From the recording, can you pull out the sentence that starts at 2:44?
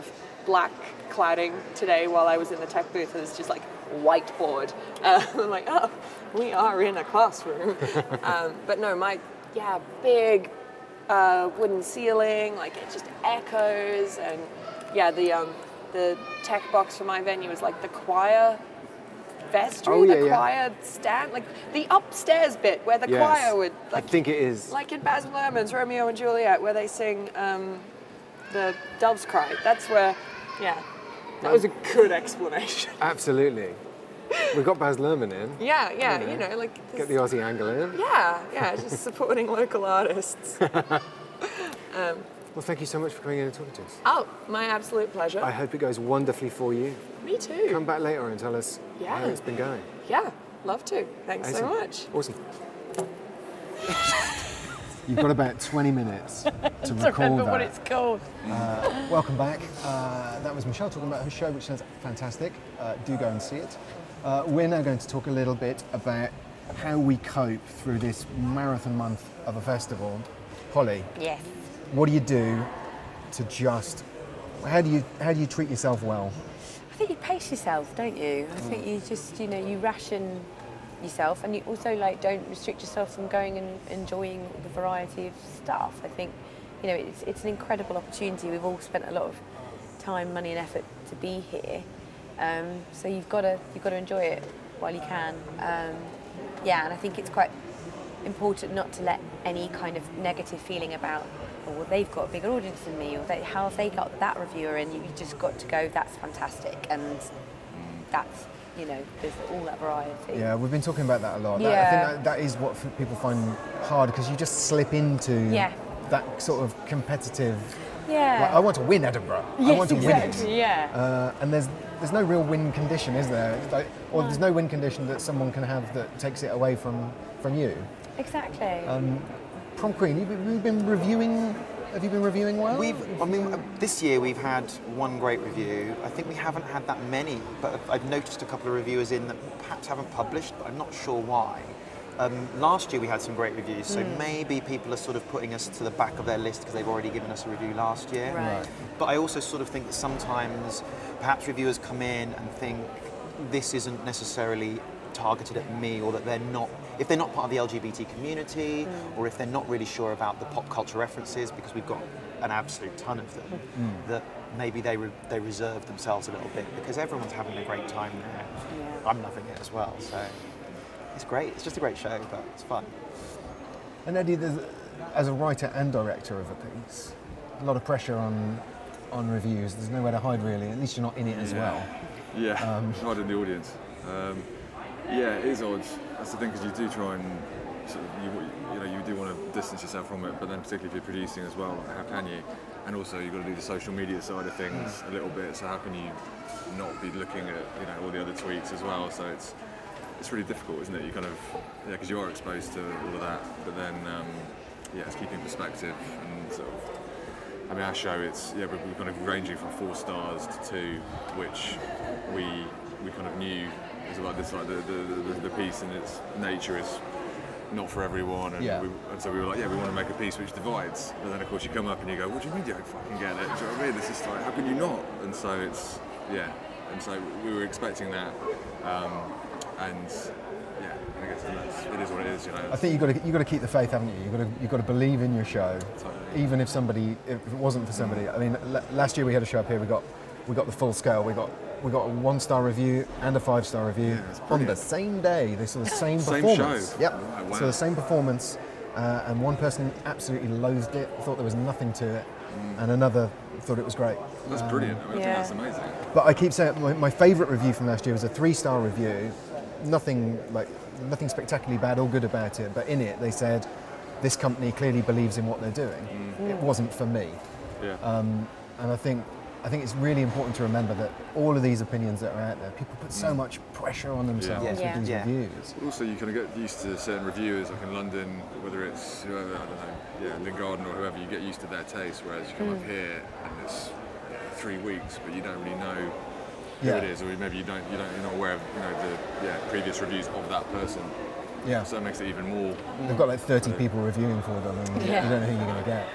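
that maybe they, re they reserve themselves a little bit because everyone's having a great time there.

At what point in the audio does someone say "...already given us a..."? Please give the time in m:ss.
2:26.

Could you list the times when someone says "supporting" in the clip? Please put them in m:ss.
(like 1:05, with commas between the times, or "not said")
0:39.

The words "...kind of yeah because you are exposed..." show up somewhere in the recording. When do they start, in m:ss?
3:21.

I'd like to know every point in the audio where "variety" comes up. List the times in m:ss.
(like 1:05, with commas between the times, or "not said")
1:24, 1:49.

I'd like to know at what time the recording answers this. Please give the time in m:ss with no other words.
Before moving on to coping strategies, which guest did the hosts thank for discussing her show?
1:00.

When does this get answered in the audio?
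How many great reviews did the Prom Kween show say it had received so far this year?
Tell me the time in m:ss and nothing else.
2:14.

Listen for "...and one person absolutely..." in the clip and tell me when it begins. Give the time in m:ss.
4:09.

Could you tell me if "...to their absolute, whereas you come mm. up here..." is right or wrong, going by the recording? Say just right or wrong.
wrong.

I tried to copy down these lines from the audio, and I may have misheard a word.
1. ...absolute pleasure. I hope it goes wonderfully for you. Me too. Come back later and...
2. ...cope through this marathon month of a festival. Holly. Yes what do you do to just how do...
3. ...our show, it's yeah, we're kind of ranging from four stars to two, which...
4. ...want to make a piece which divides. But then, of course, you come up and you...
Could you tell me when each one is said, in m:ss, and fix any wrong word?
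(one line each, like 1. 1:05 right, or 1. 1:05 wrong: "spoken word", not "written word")
1. 0:44 right
2. 1:07 right
3. 3:27 right
4. 3:39 right.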